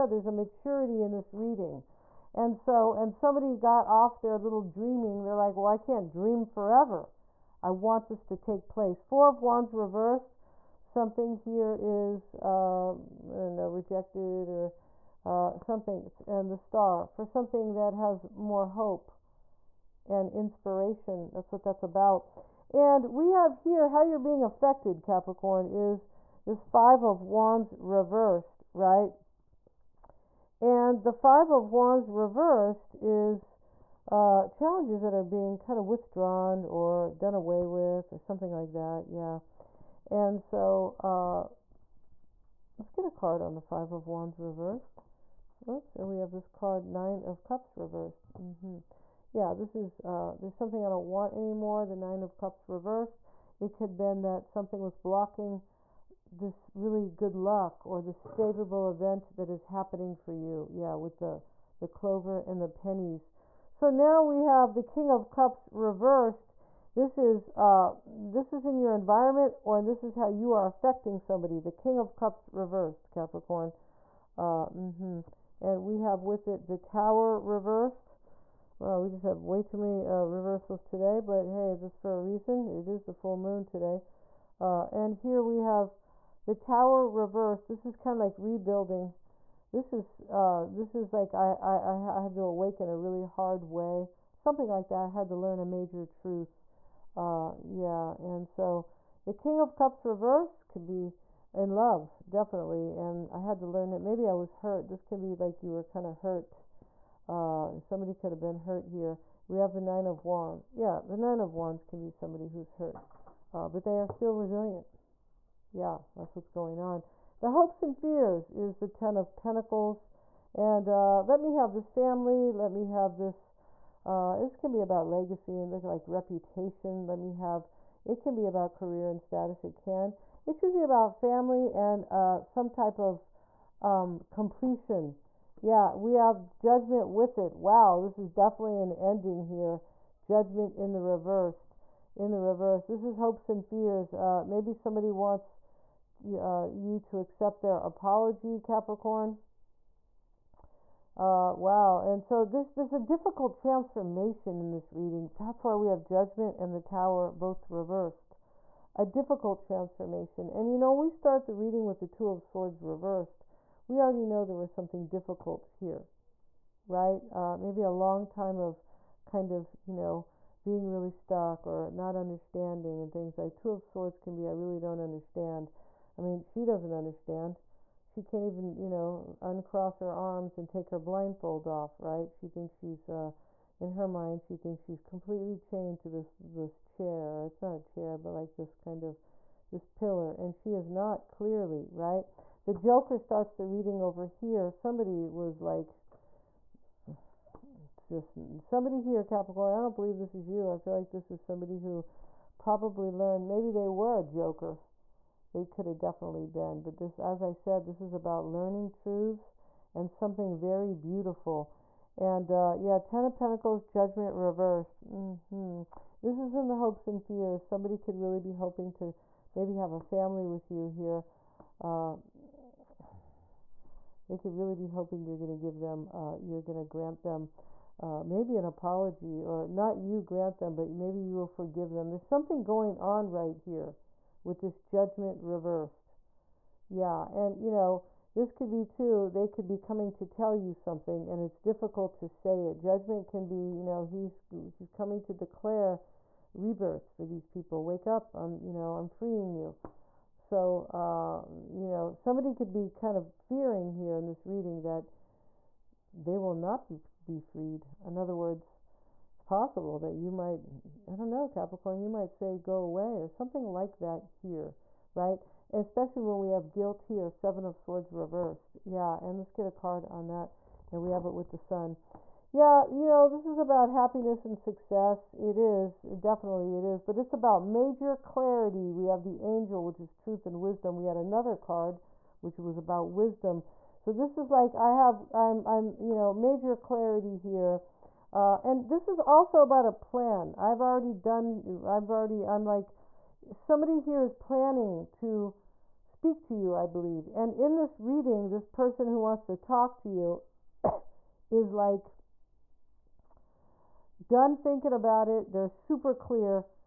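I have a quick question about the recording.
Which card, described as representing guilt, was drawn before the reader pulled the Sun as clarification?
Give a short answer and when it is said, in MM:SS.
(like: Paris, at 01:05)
Seven of Swords reversed, at 04:27.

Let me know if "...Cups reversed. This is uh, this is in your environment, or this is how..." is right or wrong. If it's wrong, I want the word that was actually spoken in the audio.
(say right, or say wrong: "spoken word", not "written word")
right.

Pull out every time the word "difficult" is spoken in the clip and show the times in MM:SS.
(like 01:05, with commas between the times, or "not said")
02:32, 02:39, 02:45, 04:01.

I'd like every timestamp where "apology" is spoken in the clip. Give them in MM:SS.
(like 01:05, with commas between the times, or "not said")
02:27, 03:48.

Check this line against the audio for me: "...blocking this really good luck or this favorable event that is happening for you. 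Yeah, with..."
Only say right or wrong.
right.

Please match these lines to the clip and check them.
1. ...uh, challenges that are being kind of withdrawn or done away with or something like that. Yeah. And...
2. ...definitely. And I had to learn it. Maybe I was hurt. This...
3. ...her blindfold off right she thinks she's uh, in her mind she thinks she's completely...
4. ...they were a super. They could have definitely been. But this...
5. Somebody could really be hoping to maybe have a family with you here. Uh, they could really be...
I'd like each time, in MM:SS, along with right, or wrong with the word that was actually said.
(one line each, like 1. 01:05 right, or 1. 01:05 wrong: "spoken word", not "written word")
1. 00:34 right
2. 01:42 right
3. 03:00 right
4. 03:23 wrong: "joker", not "super"
5. 03:37 right.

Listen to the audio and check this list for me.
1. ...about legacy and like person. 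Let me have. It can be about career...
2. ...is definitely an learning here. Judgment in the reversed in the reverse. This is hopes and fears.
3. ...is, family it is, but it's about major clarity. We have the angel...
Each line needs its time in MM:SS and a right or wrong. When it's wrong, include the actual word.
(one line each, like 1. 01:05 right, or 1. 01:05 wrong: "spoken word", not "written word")
1. 02:04 wrong: "reputation", not "person"
2. 02:18 wrong: "ending", not "learning"
3. 04:35 wrong: "definitely", not "family".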